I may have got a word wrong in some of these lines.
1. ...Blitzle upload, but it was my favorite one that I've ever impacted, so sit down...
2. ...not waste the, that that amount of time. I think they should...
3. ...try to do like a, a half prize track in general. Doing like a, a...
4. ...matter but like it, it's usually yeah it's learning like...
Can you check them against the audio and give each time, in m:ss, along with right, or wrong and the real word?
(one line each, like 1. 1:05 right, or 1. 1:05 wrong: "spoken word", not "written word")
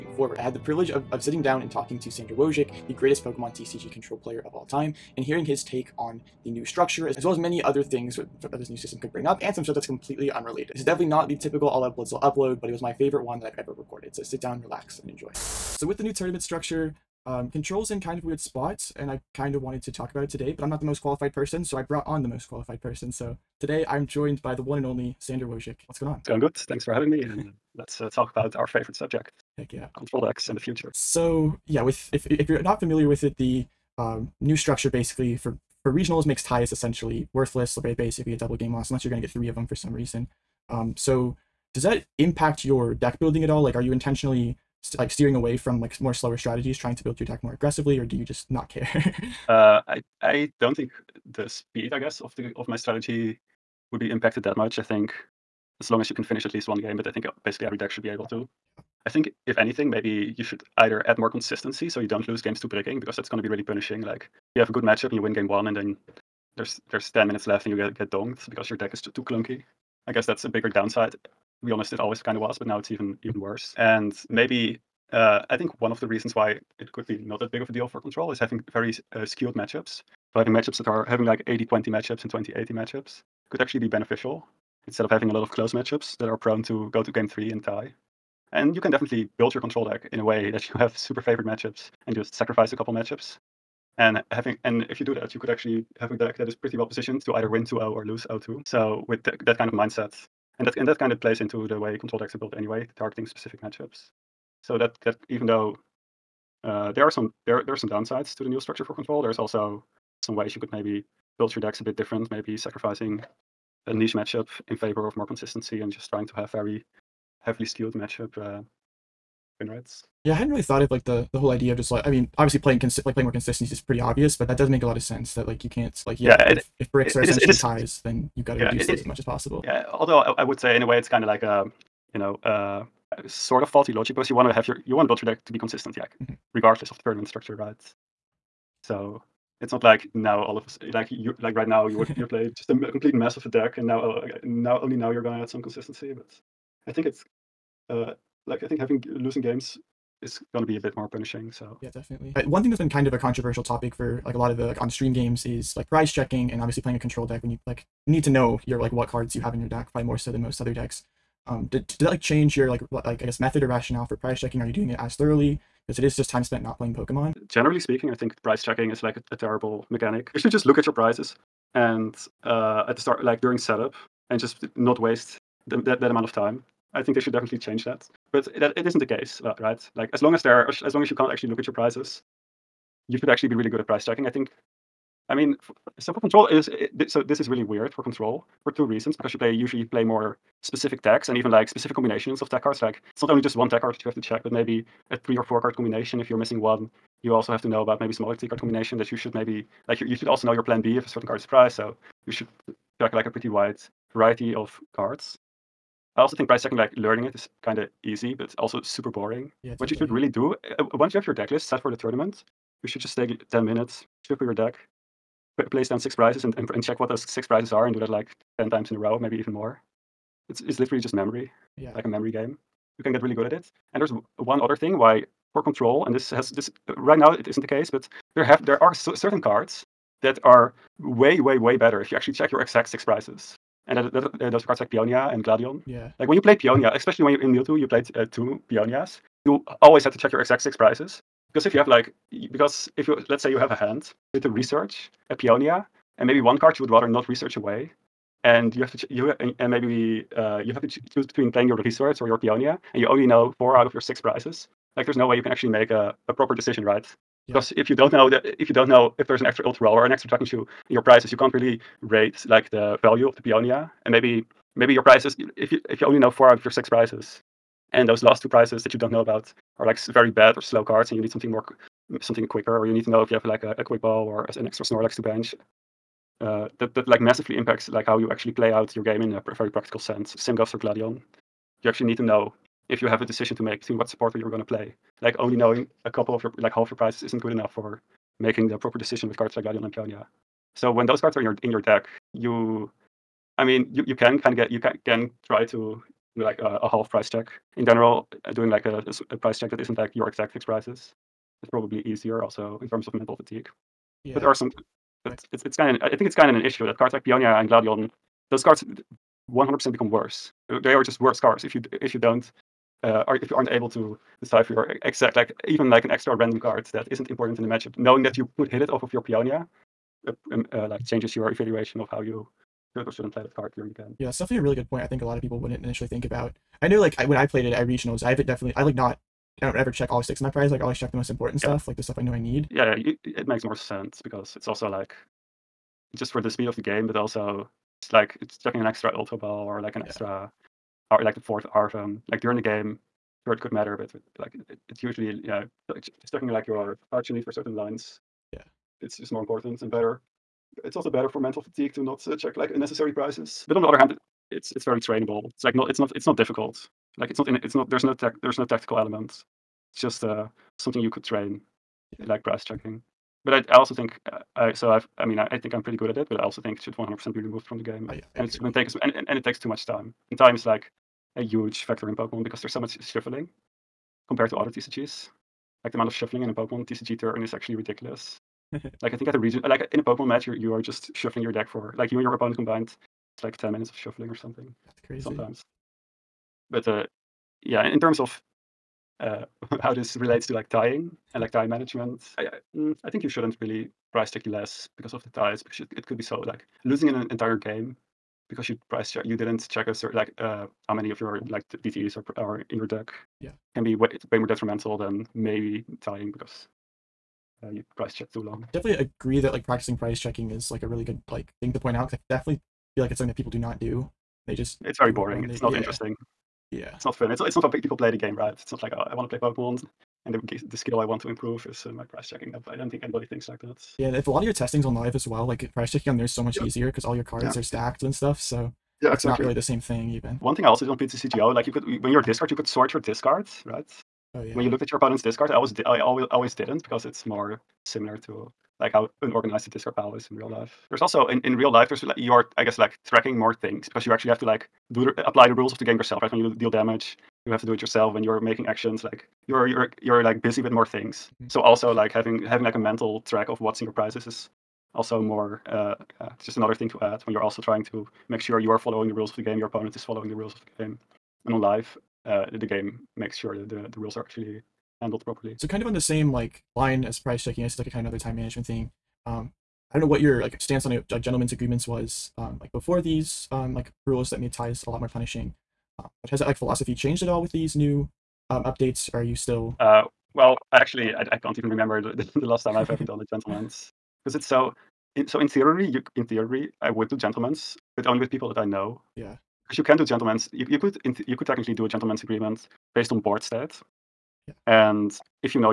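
1. 0:11 wrong: "recorded", not "impacted"
2. 2:54 right
3. 4:55 wrong: "check", not "track"
4. 5:43 wrong: "checking", not "learning".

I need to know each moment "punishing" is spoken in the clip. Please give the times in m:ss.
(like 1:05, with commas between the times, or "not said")
1:03, 2:31, 7:55.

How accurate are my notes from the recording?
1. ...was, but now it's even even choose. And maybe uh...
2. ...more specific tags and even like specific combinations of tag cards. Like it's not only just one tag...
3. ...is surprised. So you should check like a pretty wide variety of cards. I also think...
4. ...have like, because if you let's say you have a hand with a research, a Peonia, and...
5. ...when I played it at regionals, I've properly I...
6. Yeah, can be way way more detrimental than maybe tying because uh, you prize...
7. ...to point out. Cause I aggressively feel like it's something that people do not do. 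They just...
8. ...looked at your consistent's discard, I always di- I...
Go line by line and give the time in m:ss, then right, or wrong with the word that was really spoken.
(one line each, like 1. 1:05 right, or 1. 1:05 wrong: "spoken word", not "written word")
1. 1:12 wrong: "worse", not "choose"
2. 3:10 right
3. 3:21 right
4. 4:01 right
5. 5:27 wrong: "definitely", not "properly"
6. 6:43 right
7. 6:51 wrong: "definitely", not "aggressively"
8. 7:14 wrong: "opponent", not "consistent".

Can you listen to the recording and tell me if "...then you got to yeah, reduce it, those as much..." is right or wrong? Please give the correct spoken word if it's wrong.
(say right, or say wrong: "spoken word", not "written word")
right.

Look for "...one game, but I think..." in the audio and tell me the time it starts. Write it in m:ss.
0:56.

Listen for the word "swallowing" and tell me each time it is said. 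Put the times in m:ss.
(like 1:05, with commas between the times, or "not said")
not said.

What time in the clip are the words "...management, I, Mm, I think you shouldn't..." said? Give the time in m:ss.
6:31.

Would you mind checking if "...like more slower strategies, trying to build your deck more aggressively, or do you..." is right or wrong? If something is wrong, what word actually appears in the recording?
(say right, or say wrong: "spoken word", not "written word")
right.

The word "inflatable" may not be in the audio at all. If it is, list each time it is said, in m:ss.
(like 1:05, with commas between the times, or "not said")
not said.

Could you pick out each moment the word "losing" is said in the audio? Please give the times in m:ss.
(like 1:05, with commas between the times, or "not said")
2:29, 6:36.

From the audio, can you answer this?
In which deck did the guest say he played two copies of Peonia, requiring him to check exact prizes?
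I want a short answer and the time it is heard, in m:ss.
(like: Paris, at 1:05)
Mewtwo, at 3:57.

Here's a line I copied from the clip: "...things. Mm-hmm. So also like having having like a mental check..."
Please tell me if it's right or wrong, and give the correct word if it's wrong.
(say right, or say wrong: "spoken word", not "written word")
wrong: "track", not "check".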